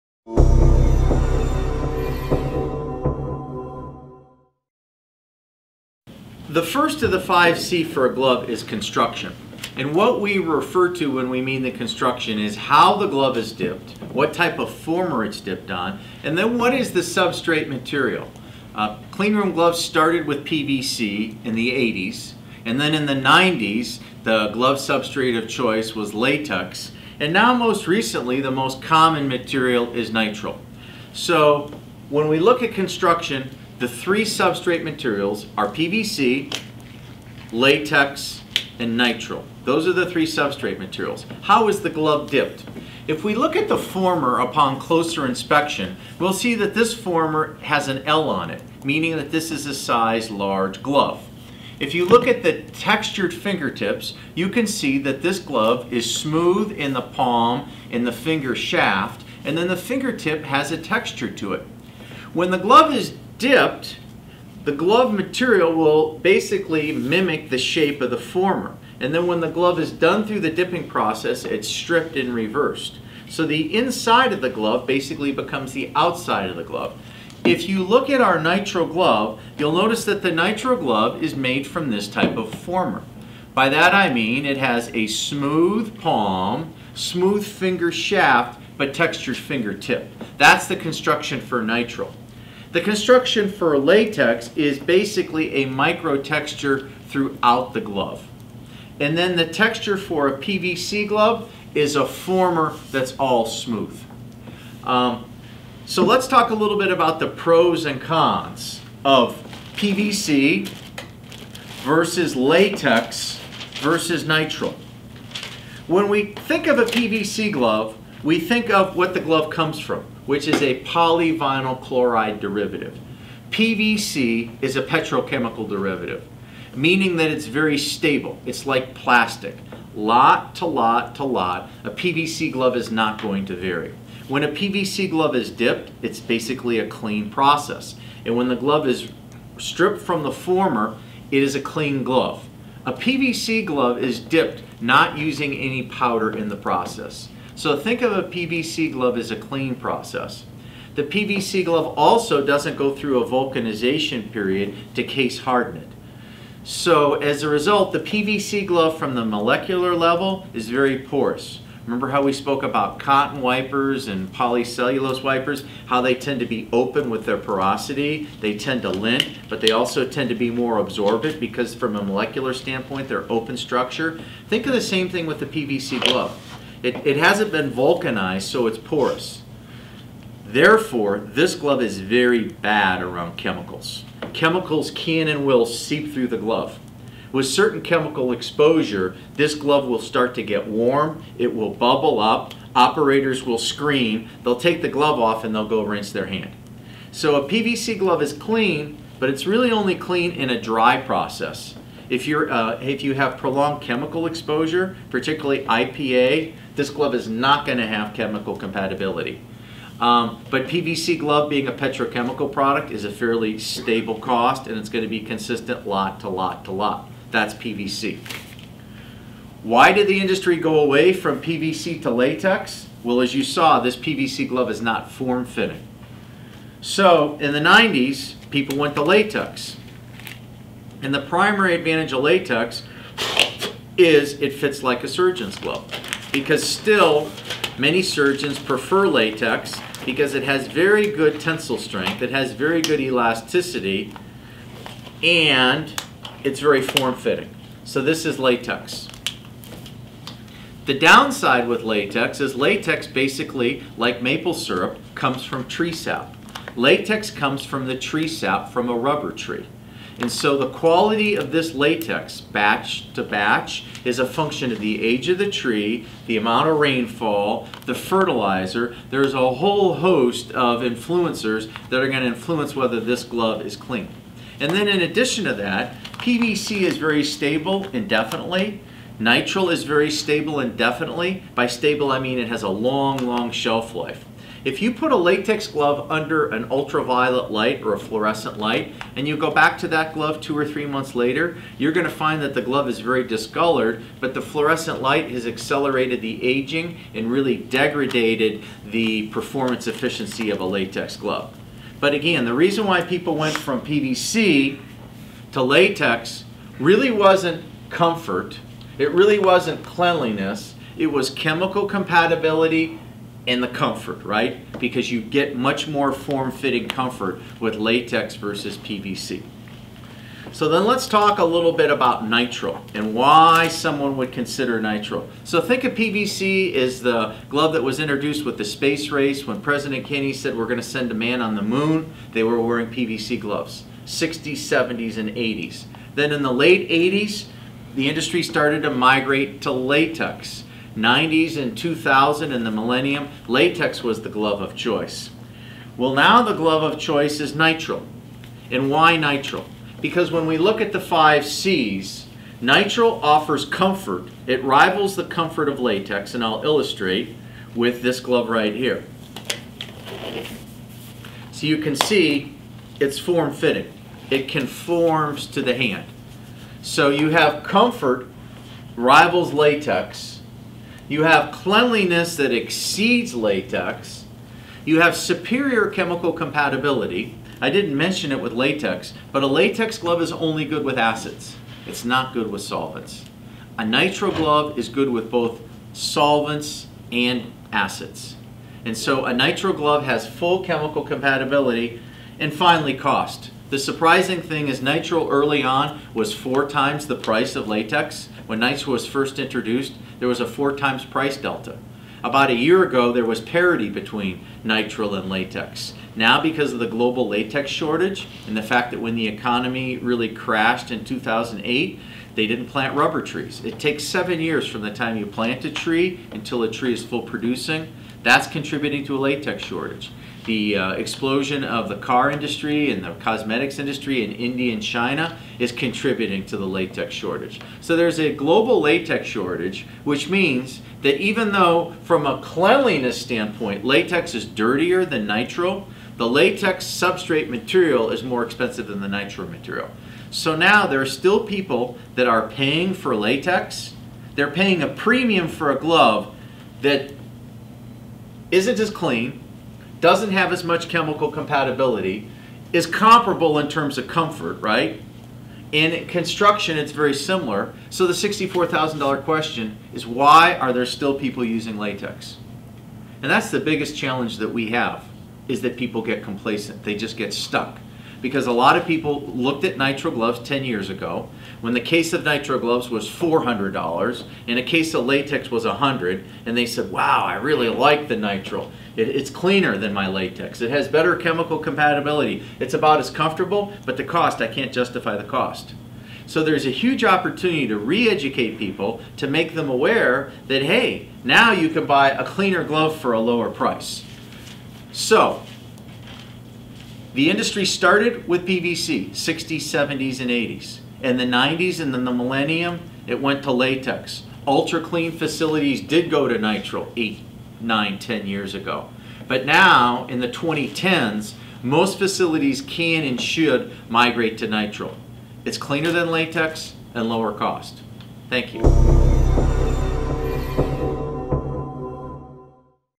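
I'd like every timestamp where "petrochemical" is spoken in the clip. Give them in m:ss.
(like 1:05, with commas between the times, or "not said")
2:04, 3:31.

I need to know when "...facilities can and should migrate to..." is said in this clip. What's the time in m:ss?
8:31.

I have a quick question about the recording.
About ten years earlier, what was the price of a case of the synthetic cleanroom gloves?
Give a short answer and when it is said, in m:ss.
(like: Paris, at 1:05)
$400, at 7:53.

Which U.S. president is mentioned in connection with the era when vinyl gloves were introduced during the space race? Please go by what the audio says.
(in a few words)
President Kennedy.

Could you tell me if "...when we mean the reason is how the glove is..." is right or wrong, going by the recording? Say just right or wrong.
wrong.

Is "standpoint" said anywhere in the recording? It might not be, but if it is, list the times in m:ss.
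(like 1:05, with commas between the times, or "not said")
2:52, 7:13.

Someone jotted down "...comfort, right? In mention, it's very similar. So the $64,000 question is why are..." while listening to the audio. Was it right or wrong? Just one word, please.
wrong.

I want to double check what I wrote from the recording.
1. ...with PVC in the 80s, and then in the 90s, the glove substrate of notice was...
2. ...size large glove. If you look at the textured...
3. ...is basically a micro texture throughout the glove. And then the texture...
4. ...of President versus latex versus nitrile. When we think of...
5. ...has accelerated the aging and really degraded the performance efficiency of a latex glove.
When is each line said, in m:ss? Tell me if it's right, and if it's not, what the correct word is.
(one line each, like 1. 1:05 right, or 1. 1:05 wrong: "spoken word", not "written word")
1. 0:20 wrong: "choice", not "notice"
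2. 0:49 right
3. 1:34 right
4. 1:49 wrong: "PVC", not "President"
5. 4:55 right.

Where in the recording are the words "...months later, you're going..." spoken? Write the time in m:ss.
4:50.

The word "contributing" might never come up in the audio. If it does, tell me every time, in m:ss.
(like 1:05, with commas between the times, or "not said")
6:58, 7:05.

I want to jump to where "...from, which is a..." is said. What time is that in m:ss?
1:59.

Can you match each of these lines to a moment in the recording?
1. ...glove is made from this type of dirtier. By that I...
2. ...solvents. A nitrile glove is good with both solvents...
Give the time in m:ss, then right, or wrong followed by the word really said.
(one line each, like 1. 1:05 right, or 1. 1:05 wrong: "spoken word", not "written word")
1. 1:20 wrong: "former", not "dirtier"
2. 6:22 right.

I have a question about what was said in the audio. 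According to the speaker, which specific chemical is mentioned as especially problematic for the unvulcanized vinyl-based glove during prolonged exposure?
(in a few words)
IPA.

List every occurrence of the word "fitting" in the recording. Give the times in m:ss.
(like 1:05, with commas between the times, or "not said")
3:45, 4:06, 5:16, 6:03.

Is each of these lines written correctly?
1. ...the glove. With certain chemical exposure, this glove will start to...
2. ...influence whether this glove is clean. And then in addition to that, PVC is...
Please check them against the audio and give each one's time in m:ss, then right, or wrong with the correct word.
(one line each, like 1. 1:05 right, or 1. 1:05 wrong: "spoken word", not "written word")
1. 3:06 right
2. 4:32 right.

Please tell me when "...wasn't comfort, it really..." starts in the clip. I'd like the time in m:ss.
5:07.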